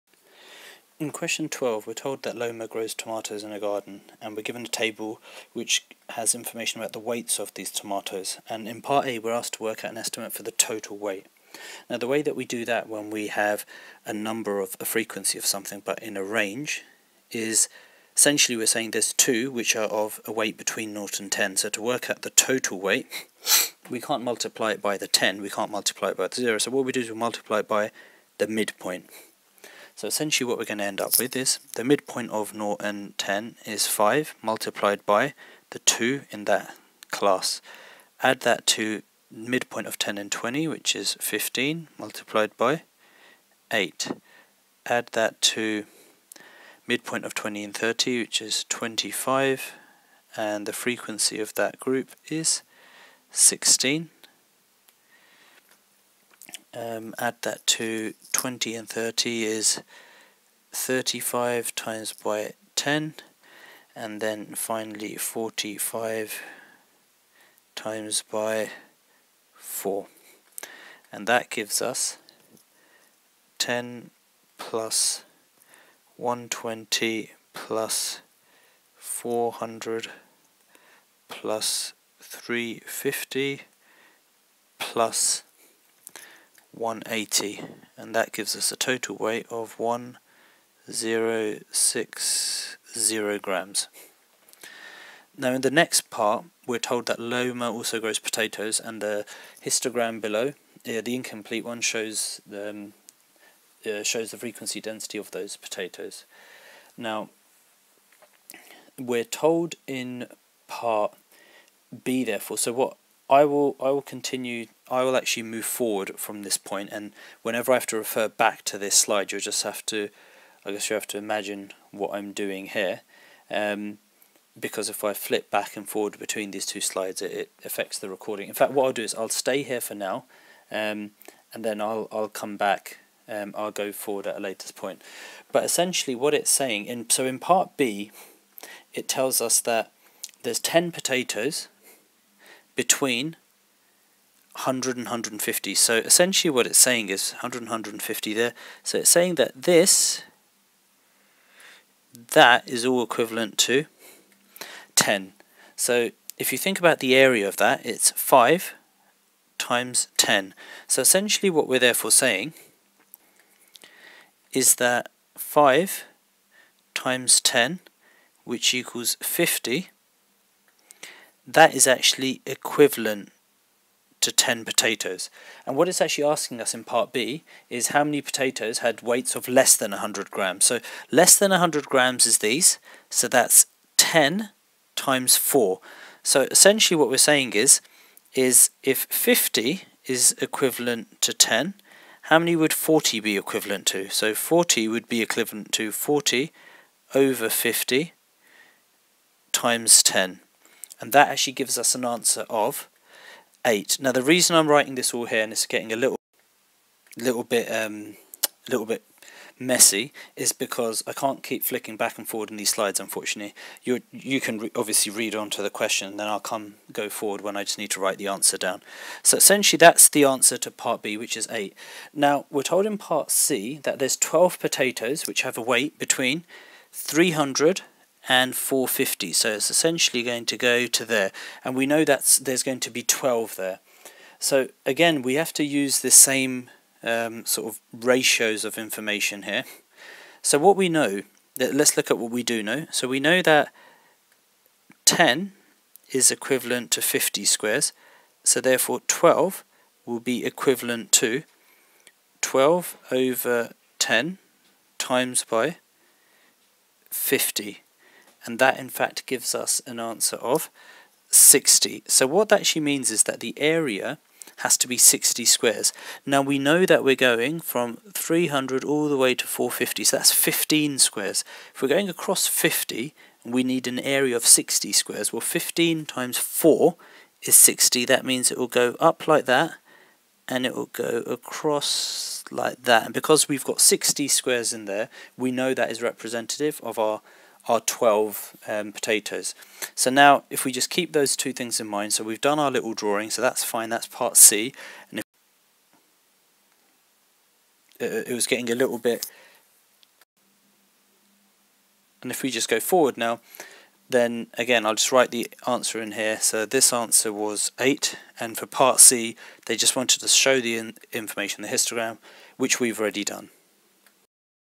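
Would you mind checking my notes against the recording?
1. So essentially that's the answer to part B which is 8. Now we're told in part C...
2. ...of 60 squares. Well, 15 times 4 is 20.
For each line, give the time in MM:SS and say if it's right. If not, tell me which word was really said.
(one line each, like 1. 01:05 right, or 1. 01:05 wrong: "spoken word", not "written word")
1. 03:39 right
2. 04:34 wrong: "60", not "20".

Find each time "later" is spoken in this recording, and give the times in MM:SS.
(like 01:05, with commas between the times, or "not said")
02:14.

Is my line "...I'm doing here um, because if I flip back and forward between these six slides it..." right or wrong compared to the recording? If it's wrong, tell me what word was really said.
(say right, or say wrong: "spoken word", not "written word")
wrong: "two", not "six".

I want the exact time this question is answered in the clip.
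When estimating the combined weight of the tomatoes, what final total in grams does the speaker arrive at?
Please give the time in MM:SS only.
01:29.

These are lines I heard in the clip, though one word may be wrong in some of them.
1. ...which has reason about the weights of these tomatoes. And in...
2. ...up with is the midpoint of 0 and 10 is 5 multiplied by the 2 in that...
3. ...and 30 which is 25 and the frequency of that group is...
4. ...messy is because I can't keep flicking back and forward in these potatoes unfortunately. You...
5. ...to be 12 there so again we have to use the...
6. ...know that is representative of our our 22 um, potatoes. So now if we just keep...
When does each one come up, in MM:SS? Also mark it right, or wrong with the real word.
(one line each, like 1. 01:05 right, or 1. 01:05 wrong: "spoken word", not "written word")
1. 00:05 wrong: "information", not "reason"
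2. 00:30 right
3. 00:47 right
4. 03:29 wrong: "slides", not "potatoes"
5. 03:52 right
6. 04:45 wrong: "12", not "22".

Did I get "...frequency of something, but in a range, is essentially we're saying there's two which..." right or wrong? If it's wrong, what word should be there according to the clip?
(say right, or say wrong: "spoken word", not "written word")
right.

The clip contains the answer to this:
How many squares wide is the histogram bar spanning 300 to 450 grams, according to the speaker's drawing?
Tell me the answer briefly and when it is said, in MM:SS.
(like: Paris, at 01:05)
15, at 04:30.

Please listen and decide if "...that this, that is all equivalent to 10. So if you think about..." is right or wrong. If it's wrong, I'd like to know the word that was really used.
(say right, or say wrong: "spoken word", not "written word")
right.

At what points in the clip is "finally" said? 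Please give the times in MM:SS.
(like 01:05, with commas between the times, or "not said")
01:04.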